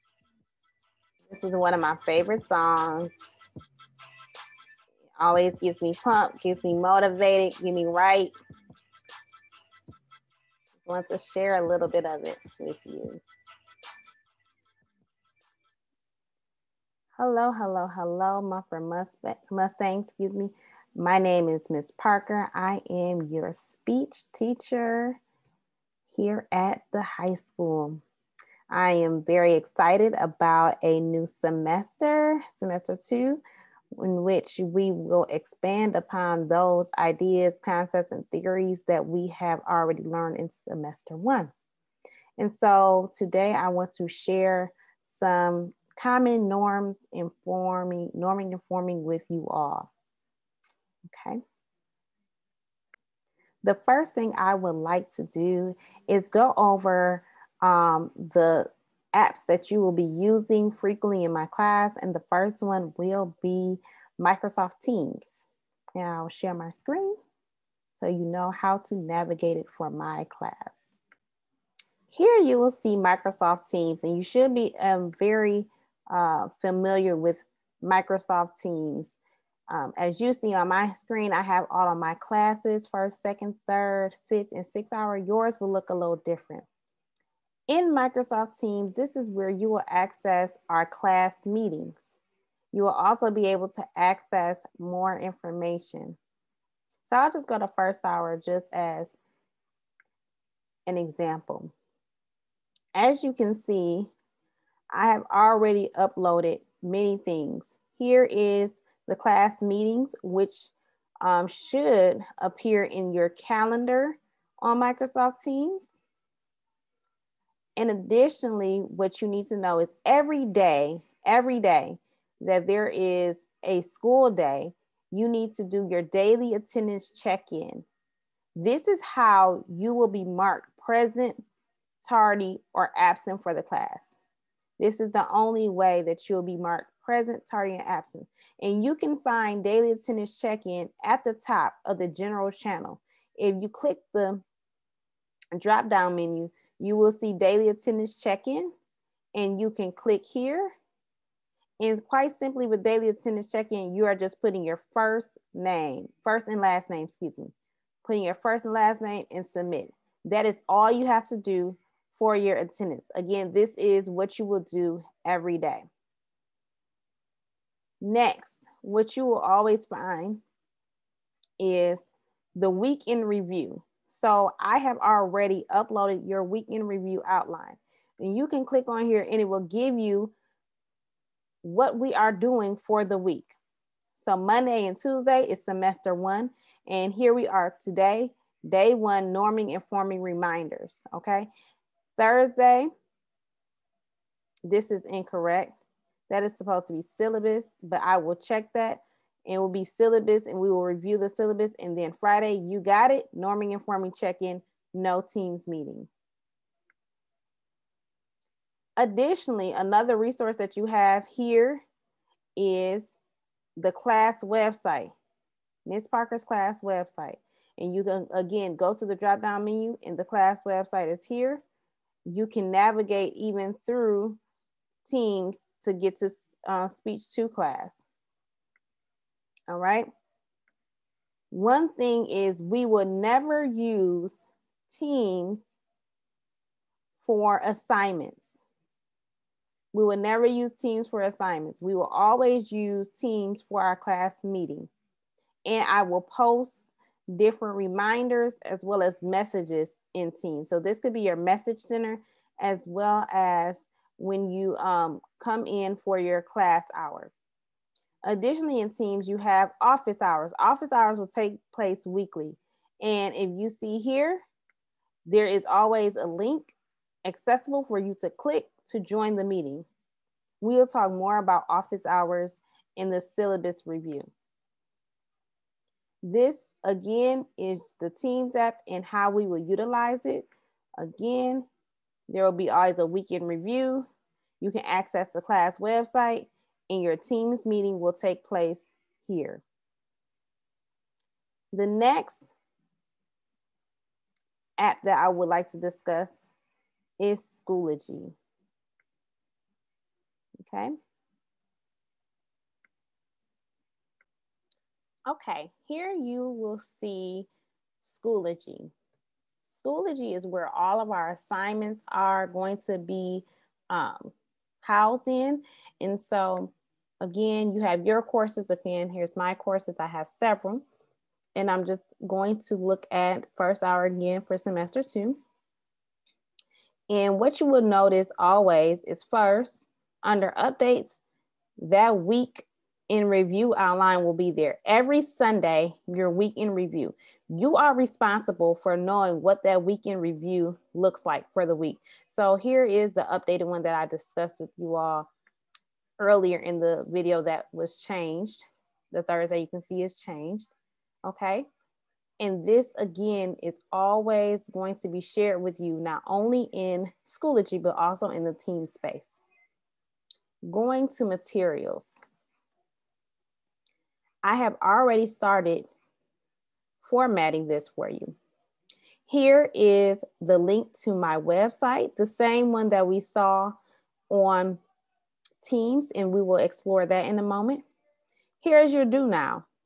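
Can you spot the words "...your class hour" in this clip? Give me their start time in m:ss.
4:16.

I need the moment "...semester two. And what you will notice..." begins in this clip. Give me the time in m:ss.
5:24.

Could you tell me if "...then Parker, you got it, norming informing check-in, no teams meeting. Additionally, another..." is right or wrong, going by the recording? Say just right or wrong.
wrong.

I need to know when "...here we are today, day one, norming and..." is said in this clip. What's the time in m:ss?
3:07.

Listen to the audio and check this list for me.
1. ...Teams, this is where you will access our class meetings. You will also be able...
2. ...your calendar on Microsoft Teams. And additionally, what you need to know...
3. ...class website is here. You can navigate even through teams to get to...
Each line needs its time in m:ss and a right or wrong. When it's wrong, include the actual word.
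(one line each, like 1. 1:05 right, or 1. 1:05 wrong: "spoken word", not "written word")
1. 1:28 right
2. 1:53 right
3. 3:40 right.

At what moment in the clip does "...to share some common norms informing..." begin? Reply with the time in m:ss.
0:43.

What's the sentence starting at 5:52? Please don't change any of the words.
And this again is always going to be shared with you, not only in Schoology, but also in the team space.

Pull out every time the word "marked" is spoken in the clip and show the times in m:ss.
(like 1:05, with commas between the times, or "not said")
2:10, 2:16.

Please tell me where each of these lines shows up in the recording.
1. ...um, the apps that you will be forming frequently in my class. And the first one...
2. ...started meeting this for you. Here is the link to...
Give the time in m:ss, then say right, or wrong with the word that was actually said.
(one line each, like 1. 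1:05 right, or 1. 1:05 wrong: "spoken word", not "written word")
1. 0:57 wrong: "using", not "forming"
2. 6:05 wrong: "formatting", not "meeting".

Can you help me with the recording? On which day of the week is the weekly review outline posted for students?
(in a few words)
Sunday.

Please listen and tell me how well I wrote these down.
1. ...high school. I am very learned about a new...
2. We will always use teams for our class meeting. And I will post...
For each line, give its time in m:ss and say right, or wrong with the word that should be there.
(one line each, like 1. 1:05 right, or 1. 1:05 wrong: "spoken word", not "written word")
1. 0:27 wrong: "excited", not "learned"
2. 4:01 right.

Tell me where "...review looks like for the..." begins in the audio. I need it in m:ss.
5:40.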